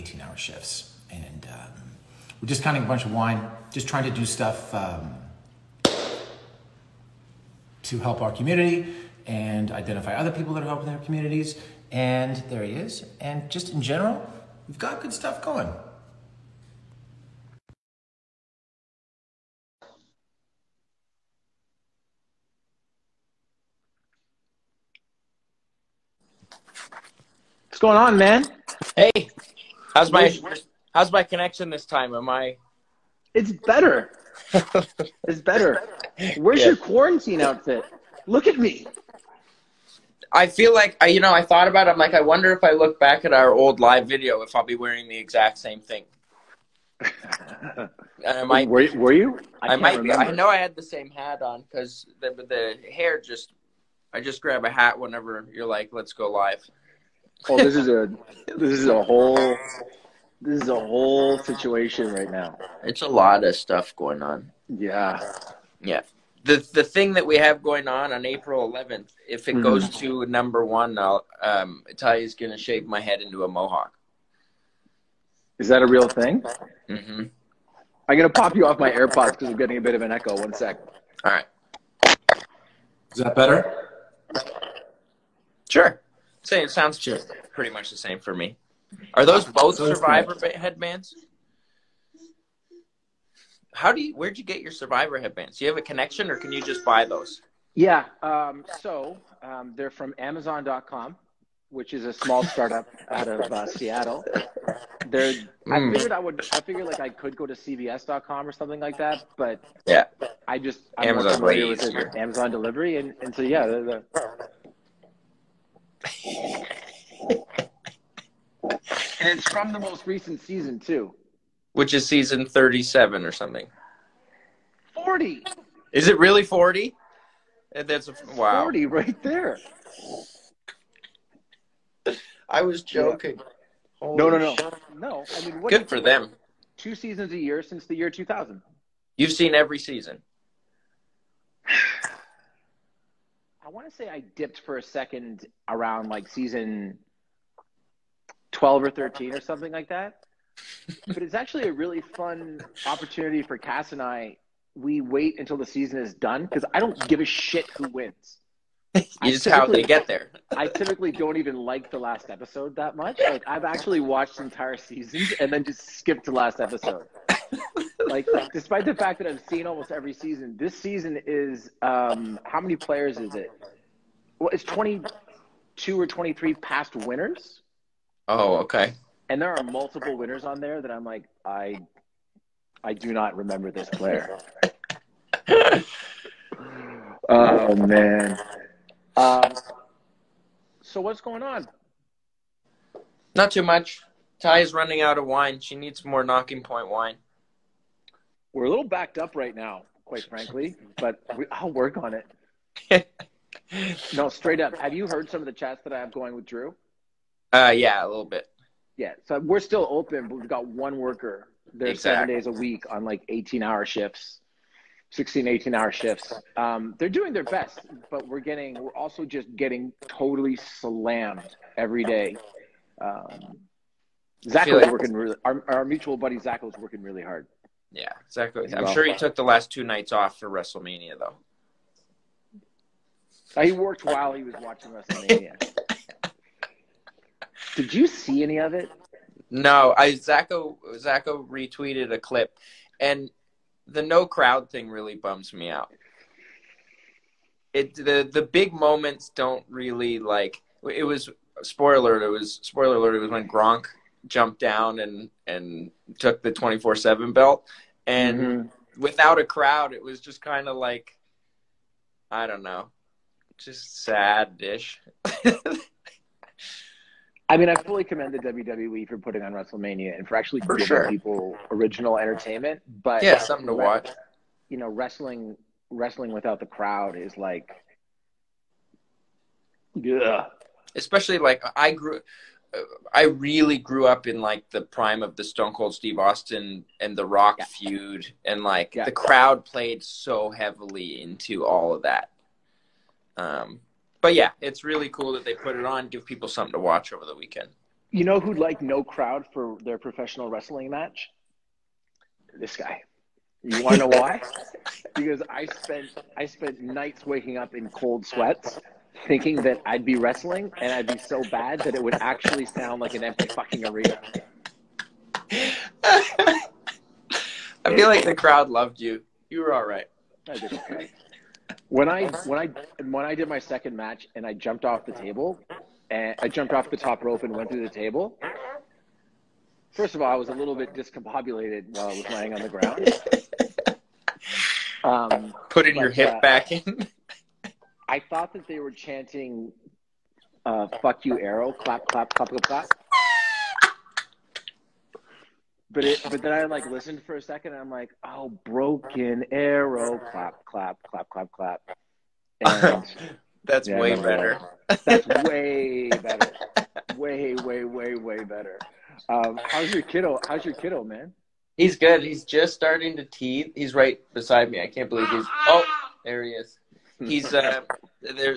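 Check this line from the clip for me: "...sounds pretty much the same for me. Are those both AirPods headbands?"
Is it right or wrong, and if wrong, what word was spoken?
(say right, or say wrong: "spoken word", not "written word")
wrong: "Survivor", not "AirPods".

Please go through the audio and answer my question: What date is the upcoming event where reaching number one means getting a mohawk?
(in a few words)
April 11th.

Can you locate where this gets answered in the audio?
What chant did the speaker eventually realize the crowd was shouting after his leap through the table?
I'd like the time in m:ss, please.
5:48.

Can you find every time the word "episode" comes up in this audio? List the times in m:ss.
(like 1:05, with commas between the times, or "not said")
2:42, 2:46.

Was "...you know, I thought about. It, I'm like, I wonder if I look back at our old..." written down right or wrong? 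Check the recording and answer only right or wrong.
right.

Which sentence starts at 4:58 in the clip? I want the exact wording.
You know who'd like no crowd for their professional wrestling match?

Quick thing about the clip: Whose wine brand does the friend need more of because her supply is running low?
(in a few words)
Nocking Point.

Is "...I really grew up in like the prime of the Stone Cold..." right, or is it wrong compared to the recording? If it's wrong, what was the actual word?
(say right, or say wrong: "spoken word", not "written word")
right.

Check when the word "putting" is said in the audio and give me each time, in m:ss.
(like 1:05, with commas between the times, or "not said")
4:29, 5:35.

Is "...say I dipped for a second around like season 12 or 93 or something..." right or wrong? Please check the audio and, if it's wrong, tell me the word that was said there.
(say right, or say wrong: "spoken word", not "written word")
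wrong: "13", not "93".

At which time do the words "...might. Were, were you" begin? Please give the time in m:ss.
0:48.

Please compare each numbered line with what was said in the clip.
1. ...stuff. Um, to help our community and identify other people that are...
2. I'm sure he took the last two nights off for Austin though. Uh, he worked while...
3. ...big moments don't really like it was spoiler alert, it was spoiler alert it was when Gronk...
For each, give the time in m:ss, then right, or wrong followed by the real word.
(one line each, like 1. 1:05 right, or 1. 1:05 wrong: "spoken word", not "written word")
1. 0:04 right
2. 3:48 wrong: "WrestleMania", not "Austin"
3. 4:08 right.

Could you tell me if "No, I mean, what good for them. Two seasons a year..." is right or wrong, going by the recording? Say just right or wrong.
right.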